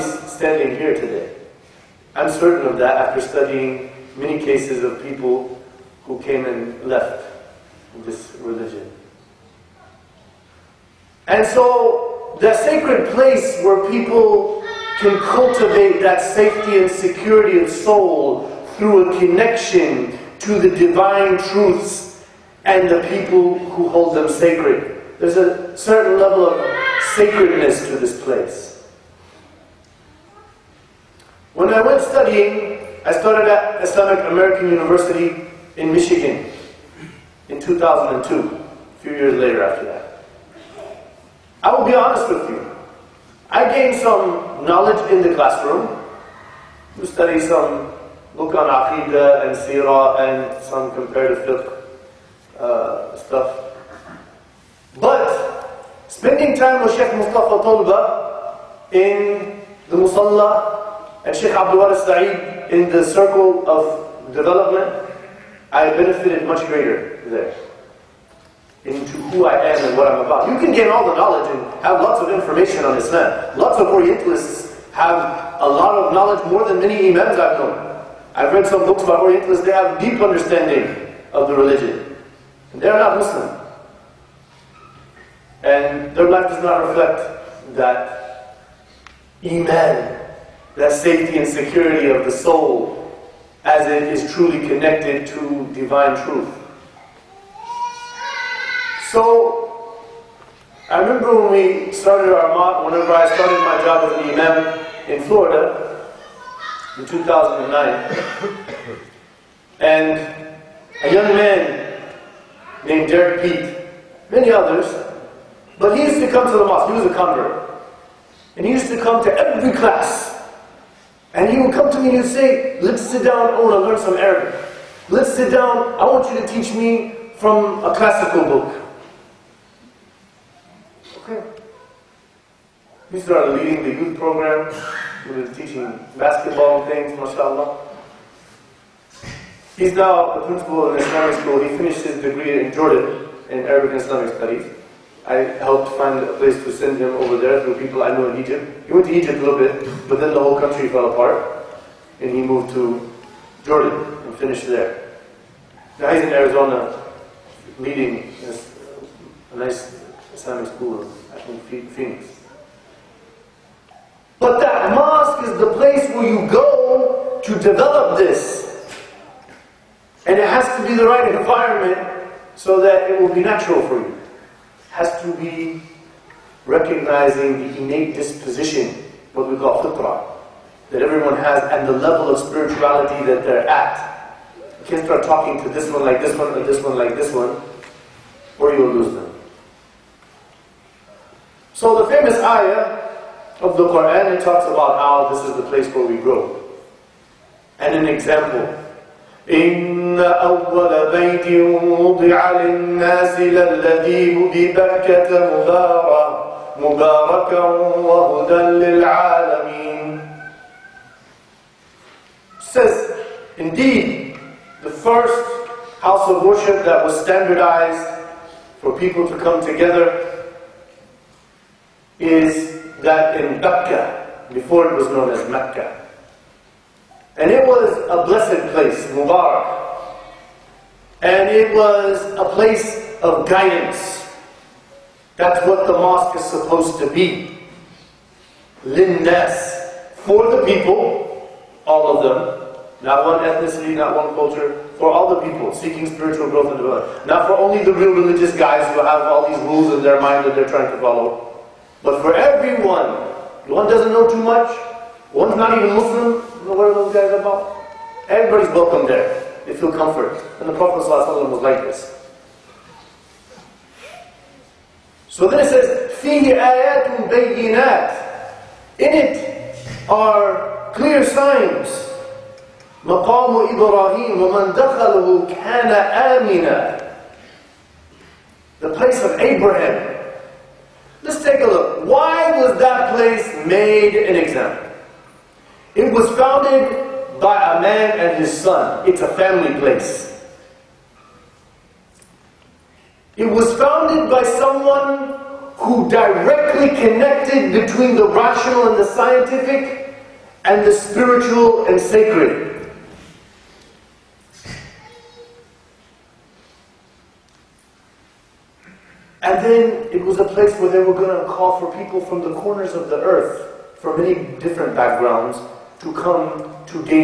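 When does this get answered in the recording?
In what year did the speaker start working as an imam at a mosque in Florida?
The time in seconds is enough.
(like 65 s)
107 s.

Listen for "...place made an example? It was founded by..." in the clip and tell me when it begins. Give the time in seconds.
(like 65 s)
283 s.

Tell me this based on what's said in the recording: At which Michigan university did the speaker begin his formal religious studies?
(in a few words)
Islamic American University.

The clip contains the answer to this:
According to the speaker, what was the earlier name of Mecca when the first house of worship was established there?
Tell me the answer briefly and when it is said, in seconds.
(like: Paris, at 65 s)
Becca, at 223 s.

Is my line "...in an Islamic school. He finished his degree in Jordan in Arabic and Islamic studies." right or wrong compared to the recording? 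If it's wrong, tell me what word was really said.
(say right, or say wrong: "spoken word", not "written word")
right.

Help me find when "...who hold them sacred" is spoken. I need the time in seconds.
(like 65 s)
23 s.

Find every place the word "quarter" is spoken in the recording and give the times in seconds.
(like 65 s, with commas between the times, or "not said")
not said.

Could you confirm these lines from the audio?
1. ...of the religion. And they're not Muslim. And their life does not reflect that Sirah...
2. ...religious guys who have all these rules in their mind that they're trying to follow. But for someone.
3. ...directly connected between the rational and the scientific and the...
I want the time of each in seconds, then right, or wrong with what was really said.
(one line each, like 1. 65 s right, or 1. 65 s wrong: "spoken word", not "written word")
1. 81 s wrong: "Iman", not "Sirah"
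2. 248 s wrong: "everyone", not "someone"
3. 296 s right.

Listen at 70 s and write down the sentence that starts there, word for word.
You can gain all the knowledge and have lots of information on Islam.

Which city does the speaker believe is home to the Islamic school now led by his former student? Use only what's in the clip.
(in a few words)
Phoenix.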